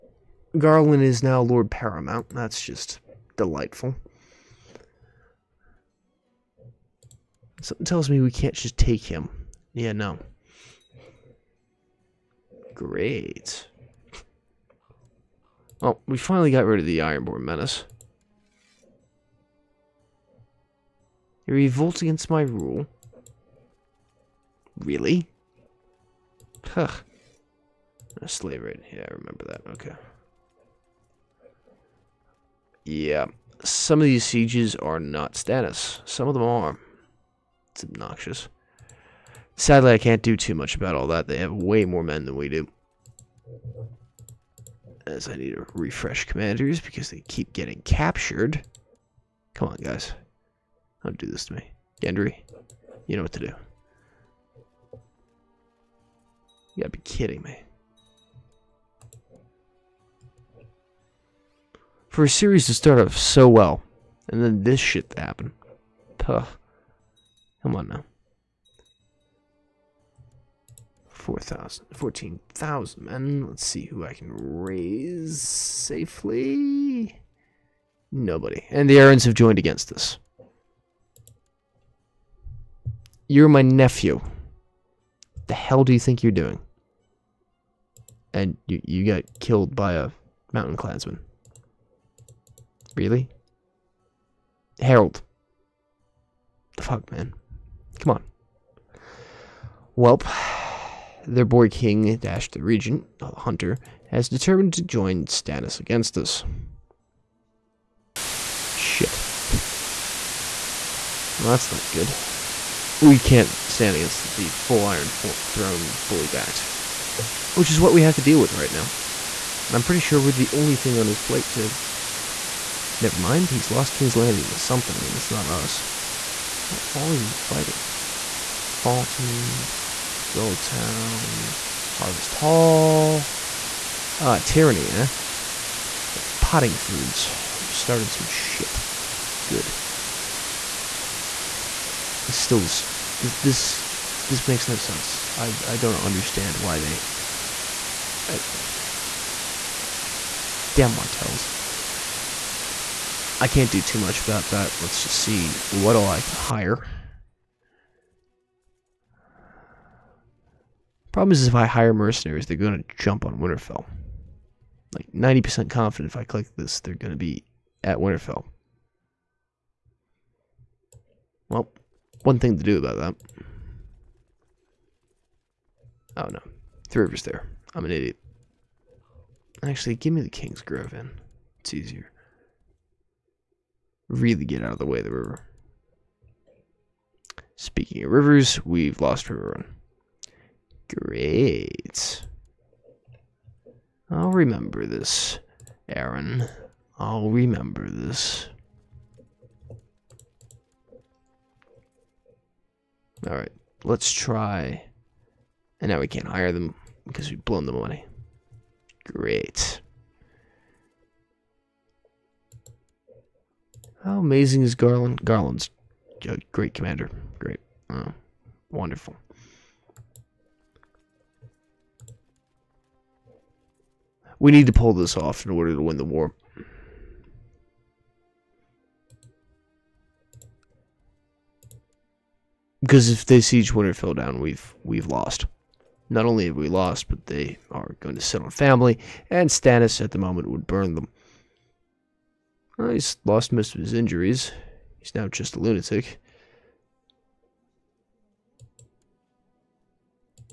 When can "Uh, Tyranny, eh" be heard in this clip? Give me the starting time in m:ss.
2:14.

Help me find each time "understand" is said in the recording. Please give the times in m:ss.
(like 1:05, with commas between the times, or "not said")
2:25.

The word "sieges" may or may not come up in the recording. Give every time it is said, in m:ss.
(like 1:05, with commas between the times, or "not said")
0:34, 3:53.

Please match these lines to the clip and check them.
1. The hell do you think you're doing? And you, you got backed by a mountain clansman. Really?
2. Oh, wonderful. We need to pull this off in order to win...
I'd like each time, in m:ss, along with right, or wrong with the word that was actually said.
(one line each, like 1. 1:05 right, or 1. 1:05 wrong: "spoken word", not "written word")
1. 1:25 wrong: "killed", not "backed"
2. 3:37 right.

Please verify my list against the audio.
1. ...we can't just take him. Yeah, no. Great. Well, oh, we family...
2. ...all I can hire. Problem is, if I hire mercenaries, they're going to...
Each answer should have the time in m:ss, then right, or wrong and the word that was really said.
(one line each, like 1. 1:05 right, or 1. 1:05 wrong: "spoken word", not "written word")
1. 0:08 wrong: "finally", not "family"
2. 2:35 right.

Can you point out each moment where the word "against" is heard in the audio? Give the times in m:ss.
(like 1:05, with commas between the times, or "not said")
0:22, 1:19, 1:45, 1:53.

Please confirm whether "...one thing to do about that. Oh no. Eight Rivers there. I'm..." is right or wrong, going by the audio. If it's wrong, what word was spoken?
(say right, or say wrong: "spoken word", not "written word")
wrong: "Three", not "Eight".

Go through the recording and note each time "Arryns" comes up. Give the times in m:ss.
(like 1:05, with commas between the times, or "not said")
1:18, 3:15.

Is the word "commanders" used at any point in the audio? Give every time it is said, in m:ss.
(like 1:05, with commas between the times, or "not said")
0:46, 3:36.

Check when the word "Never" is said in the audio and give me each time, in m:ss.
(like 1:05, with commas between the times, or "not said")
2:02.